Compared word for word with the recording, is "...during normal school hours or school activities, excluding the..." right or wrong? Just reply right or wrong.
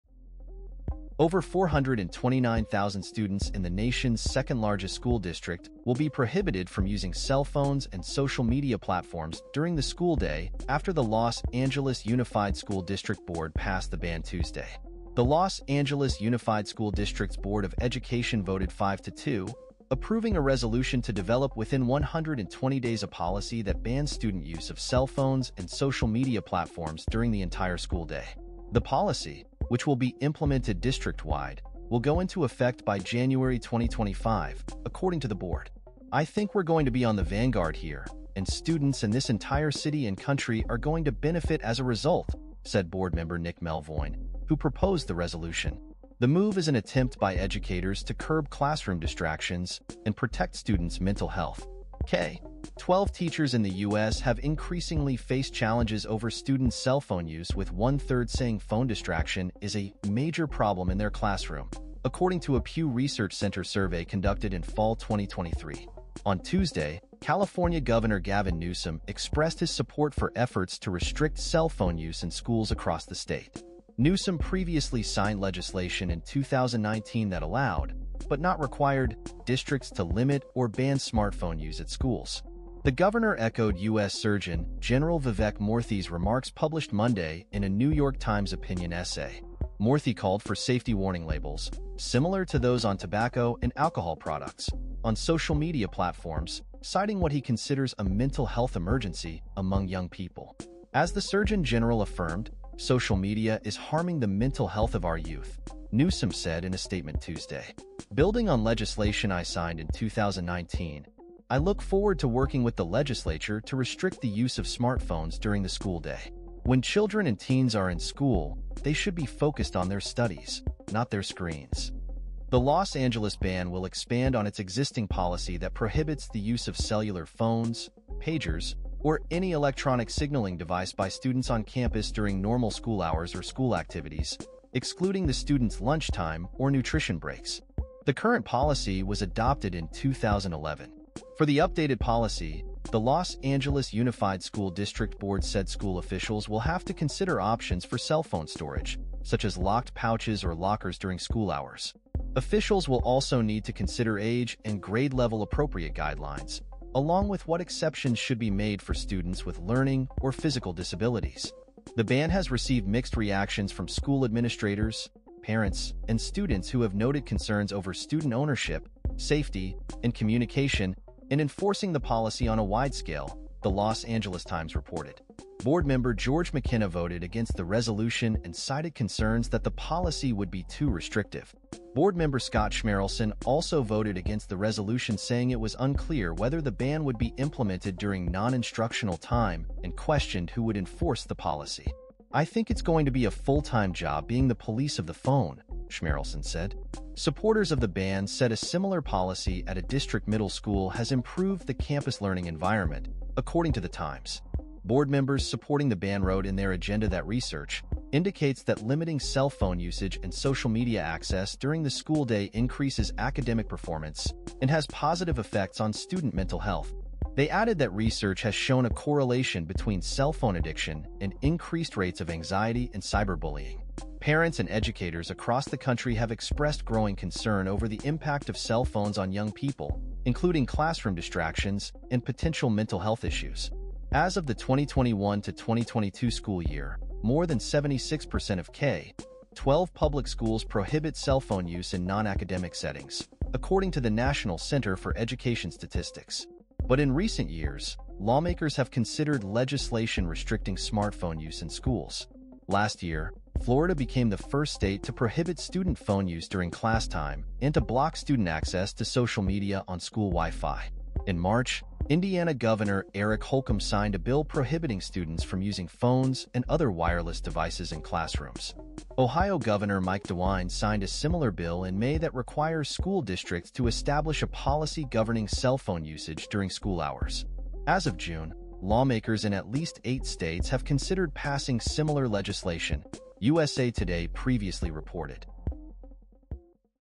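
right.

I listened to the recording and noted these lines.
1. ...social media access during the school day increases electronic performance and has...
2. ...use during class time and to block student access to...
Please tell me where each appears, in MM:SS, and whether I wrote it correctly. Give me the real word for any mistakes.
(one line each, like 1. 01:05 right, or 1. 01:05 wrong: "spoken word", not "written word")
1. 03:30 wrong: "academic", not "electronic"
2. 04:16 right.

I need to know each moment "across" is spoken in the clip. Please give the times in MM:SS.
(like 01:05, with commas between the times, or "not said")
01:12, 03:45.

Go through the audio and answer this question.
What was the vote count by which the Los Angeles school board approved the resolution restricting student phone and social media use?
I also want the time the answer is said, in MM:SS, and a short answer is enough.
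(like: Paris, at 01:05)
5 to 2, at 00:18.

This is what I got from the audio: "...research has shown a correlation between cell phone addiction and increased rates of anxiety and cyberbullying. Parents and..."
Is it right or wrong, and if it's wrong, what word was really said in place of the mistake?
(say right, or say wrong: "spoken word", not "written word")
right.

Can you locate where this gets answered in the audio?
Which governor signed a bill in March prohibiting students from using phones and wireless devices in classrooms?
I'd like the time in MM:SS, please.
04:23.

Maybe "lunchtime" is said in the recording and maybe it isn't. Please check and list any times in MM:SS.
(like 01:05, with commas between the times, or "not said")
02:15.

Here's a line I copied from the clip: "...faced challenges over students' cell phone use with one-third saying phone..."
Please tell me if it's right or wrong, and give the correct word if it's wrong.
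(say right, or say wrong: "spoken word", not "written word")
right.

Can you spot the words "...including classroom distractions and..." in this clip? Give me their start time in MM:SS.
03:50.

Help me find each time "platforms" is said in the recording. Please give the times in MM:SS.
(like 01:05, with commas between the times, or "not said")
00:08, 00:26, 01:35.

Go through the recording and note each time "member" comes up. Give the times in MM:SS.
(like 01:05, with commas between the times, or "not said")
00:43, 02:55, 03:02, 03:25.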